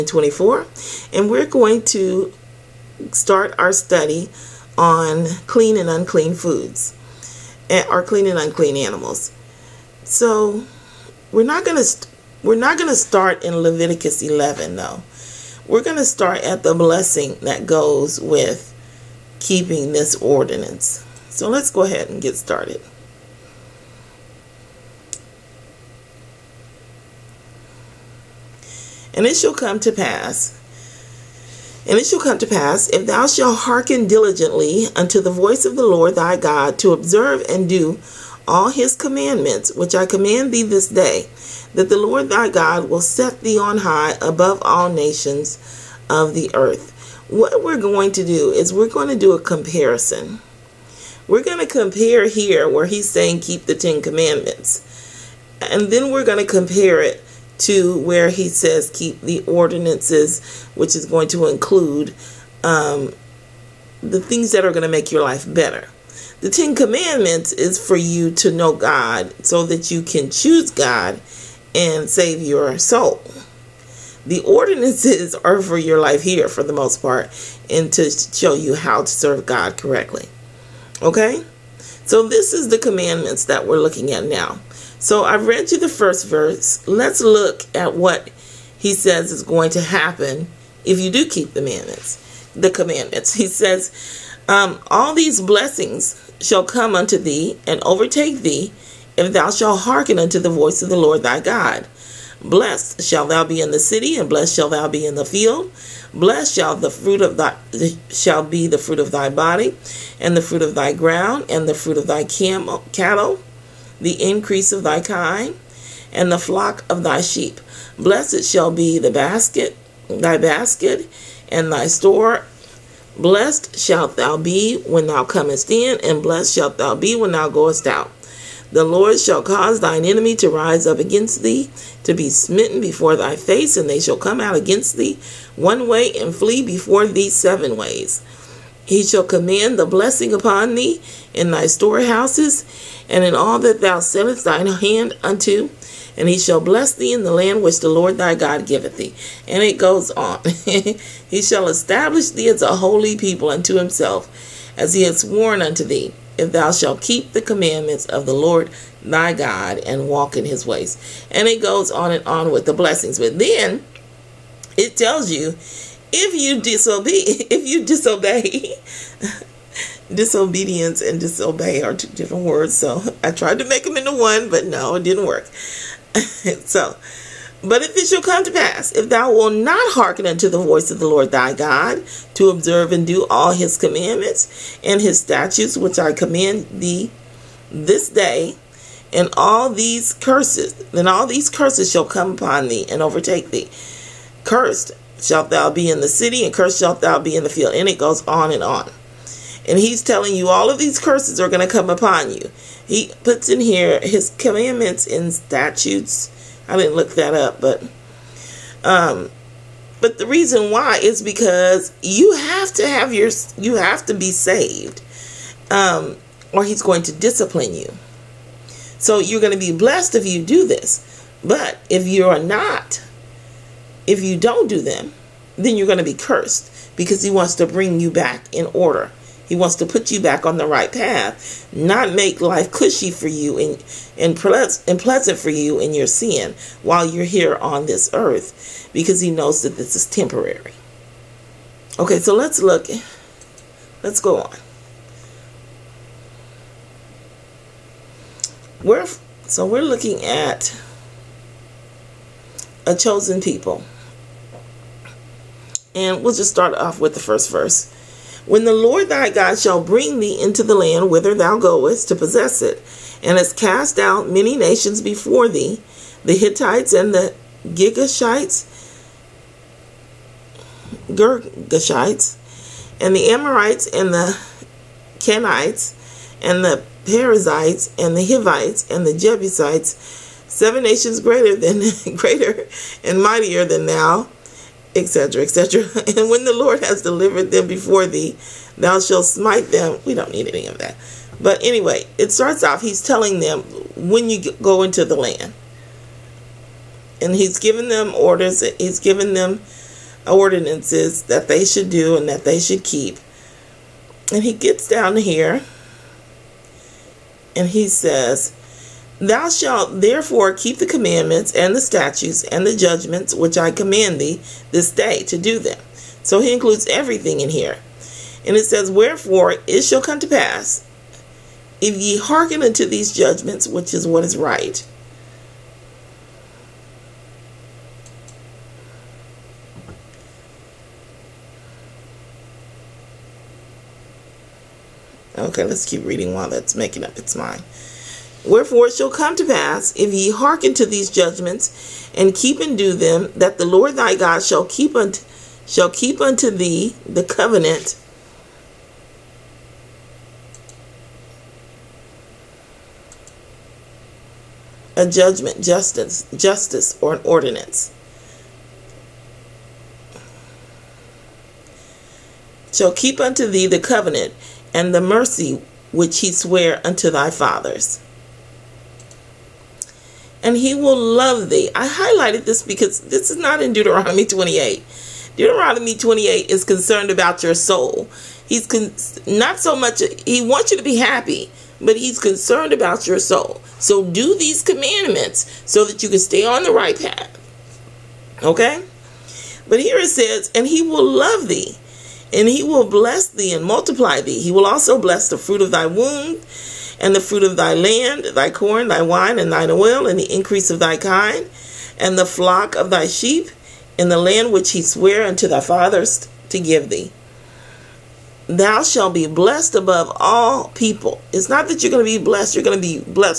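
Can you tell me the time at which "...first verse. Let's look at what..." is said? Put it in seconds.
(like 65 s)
85 s.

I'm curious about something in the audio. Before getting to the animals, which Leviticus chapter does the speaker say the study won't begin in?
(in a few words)
Leviticus 11.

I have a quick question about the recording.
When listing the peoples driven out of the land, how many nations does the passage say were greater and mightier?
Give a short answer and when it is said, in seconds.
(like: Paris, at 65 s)
7, at 280 s.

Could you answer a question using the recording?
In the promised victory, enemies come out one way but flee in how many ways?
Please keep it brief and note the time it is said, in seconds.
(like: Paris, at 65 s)
7, at 137 s.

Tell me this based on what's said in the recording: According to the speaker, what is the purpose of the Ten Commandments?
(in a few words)
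To know God.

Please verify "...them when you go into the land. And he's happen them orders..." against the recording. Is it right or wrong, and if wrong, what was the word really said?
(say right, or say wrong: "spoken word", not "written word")
wrong: "given", not "happen".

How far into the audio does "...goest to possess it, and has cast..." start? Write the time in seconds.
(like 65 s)
261 s.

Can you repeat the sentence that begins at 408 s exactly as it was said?
Thou shalt be blessed above all people.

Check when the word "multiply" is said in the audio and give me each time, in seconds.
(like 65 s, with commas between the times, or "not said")
393 s.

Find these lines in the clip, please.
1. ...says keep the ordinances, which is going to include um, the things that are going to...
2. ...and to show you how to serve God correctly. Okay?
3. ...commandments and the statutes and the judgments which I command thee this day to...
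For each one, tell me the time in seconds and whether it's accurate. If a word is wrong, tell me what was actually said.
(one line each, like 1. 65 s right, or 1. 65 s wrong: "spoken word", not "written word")
1. 58 s right
2. 77 s right
3. 310 s right.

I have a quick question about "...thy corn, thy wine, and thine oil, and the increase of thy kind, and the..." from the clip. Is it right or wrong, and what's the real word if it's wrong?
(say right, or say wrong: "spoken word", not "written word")
right.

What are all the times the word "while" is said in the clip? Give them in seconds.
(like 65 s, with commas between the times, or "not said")
236 s, 336 s.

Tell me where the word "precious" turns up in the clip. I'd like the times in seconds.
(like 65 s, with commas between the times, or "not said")
not said.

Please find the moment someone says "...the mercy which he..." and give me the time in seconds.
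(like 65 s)
364 s.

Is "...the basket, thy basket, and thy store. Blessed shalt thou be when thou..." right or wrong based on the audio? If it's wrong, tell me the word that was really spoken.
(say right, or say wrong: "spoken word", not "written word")
right.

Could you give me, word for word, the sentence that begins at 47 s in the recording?
What we're going to do is we're going to do a comparison.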